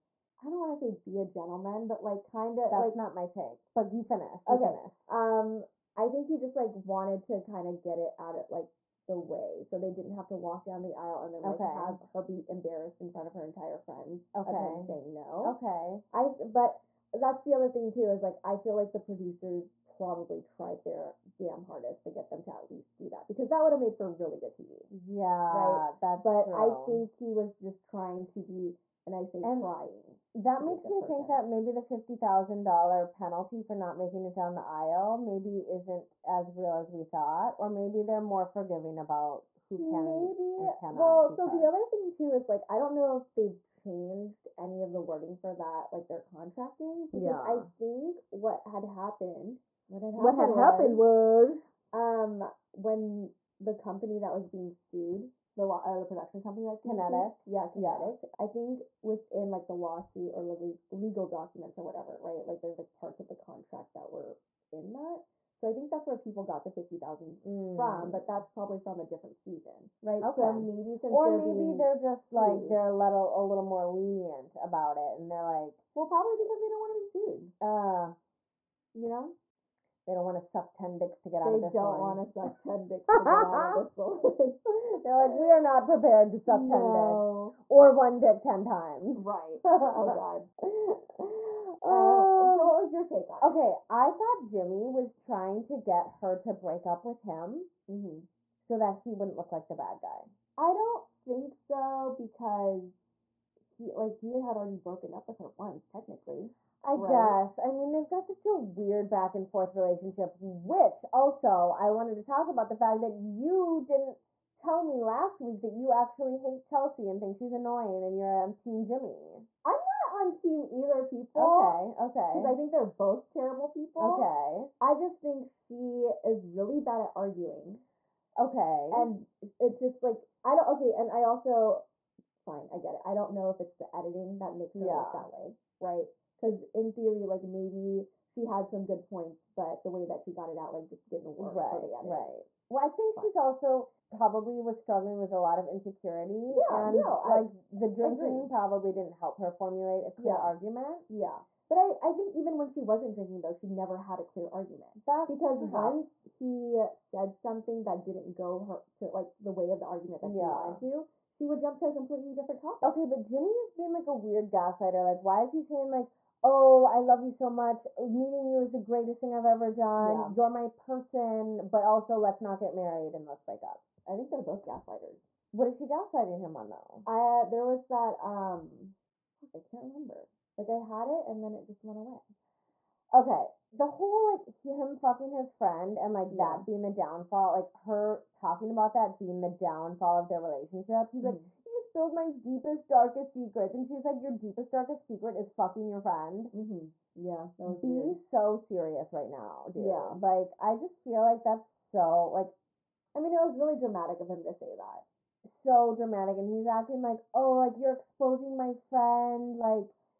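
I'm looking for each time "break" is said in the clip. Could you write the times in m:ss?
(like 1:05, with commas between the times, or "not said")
1:36, 2:53.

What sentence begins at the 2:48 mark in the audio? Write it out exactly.
Meeting you is the greatest thing I've ever done.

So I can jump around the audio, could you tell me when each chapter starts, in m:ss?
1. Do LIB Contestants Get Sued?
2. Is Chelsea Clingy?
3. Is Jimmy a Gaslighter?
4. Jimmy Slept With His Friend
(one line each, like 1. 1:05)
1. 0:29
2. 1:52
3. 2:42
4. 3:02.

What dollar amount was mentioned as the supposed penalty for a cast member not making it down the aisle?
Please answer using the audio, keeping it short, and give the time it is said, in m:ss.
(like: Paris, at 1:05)
$50,000, at 0:31.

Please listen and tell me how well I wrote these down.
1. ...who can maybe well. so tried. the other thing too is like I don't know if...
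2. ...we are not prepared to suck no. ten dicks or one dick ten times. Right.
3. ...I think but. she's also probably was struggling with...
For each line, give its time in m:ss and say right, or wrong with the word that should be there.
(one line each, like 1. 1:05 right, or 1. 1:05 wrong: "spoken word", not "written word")
1. 0:39 wrong: "charged", not "tried"
2. 1:25 right
3. 2:22 right.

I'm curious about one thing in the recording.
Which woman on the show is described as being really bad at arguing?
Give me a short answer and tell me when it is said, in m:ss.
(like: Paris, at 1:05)
Chelsea, at 1:56.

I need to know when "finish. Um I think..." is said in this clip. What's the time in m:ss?
0:04.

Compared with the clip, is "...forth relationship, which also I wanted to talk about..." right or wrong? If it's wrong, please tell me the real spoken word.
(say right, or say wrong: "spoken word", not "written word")
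right.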